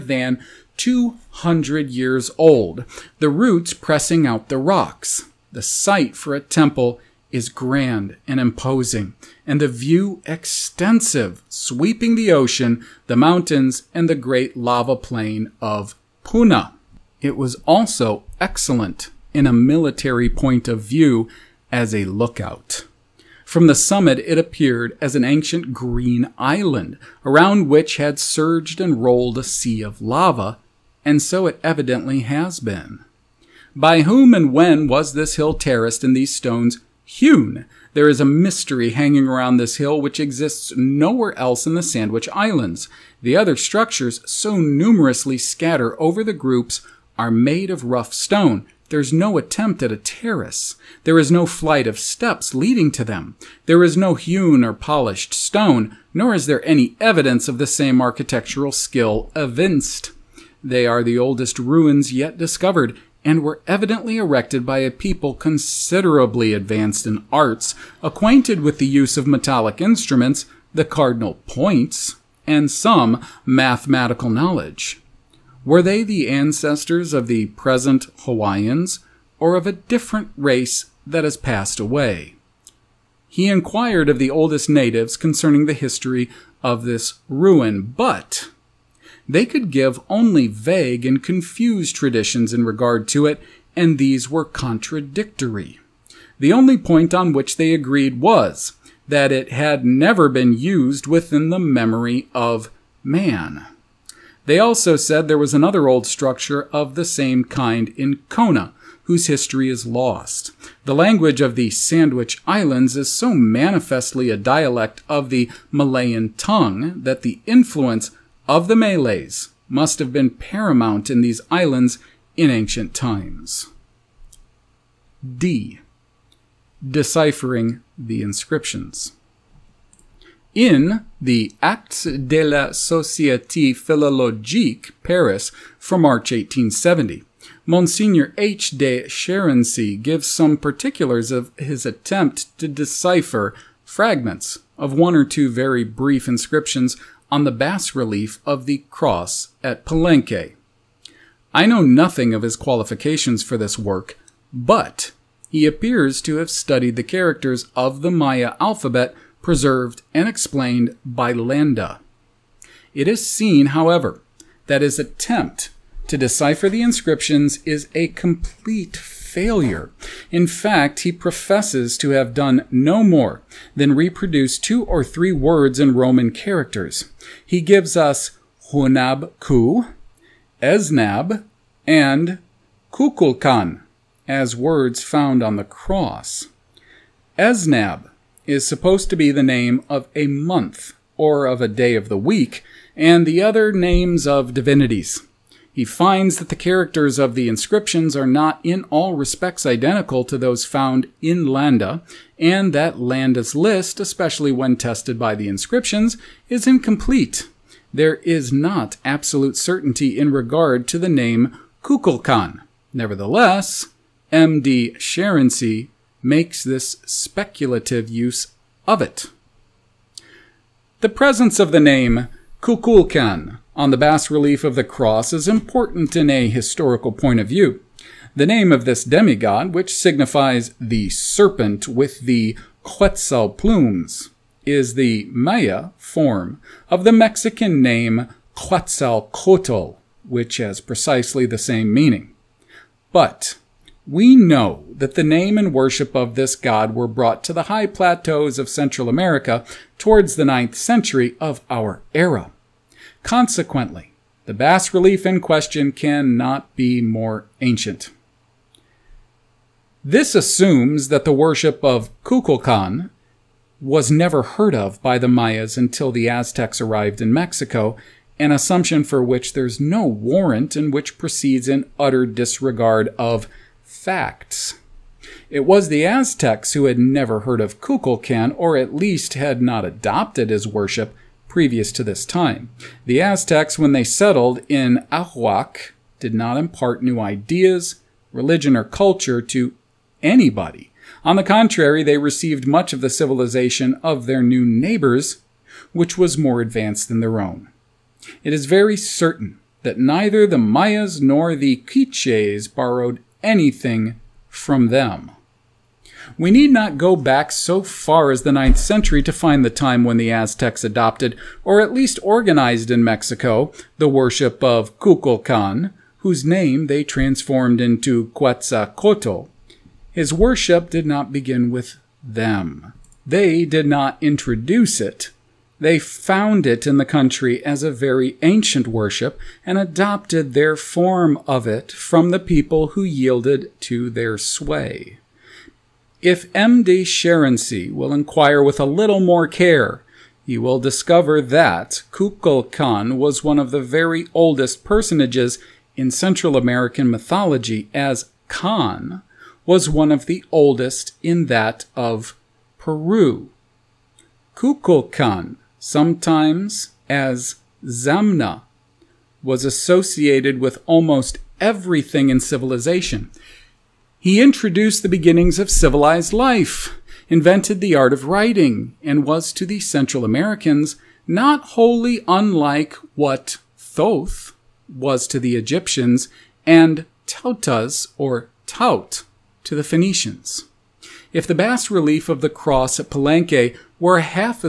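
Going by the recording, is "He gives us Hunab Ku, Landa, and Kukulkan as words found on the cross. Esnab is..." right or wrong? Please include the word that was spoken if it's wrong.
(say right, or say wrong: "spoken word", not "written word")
wrong: "Esnab", not "Landa".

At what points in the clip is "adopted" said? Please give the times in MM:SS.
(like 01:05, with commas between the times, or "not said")
04:39, 05:10, 05:29.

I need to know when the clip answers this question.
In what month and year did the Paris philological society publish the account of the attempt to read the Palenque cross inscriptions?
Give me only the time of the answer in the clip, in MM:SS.
02:15.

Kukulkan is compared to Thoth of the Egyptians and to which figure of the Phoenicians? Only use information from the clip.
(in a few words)
Taut.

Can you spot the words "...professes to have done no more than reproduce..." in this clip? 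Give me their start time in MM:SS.
02:51.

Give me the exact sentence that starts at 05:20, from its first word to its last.
His worship did not begin with them.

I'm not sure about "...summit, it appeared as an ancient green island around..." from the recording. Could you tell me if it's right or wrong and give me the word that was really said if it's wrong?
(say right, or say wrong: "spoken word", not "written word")
right.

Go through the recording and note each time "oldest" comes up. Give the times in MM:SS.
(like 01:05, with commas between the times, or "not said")
01:01, 01:24, 05:44, 05:50.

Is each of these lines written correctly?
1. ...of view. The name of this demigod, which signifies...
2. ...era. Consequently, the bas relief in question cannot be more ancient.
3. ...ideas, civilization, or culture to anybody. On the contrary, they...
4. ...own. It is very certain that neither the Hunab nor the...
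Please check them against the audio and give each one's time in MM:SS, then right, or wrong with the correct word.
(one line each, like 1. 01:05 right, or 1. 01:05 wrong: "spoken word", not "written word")
1. 03:47 right
2. 04:12 right
3. 04:47 wrong: "religion", not "civilization"
4. 04:57 wrong: "Mayas", not "Hunab".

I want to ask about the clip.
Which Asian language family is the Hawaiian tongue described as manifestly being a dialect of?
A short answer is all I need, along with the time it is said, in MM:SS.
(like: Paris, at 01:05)
Malayan, at 01:55.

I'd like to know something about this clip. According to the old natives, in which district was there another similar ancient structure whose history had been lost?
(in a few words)
Kona.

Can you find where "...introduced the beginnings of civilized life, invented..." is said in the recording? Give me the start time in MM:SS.
06:04.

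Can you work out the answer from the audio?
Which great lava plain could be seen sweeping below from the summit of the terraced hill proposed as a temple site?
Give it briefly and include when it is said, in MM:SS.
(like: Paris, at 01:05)
Puna, at 00:16.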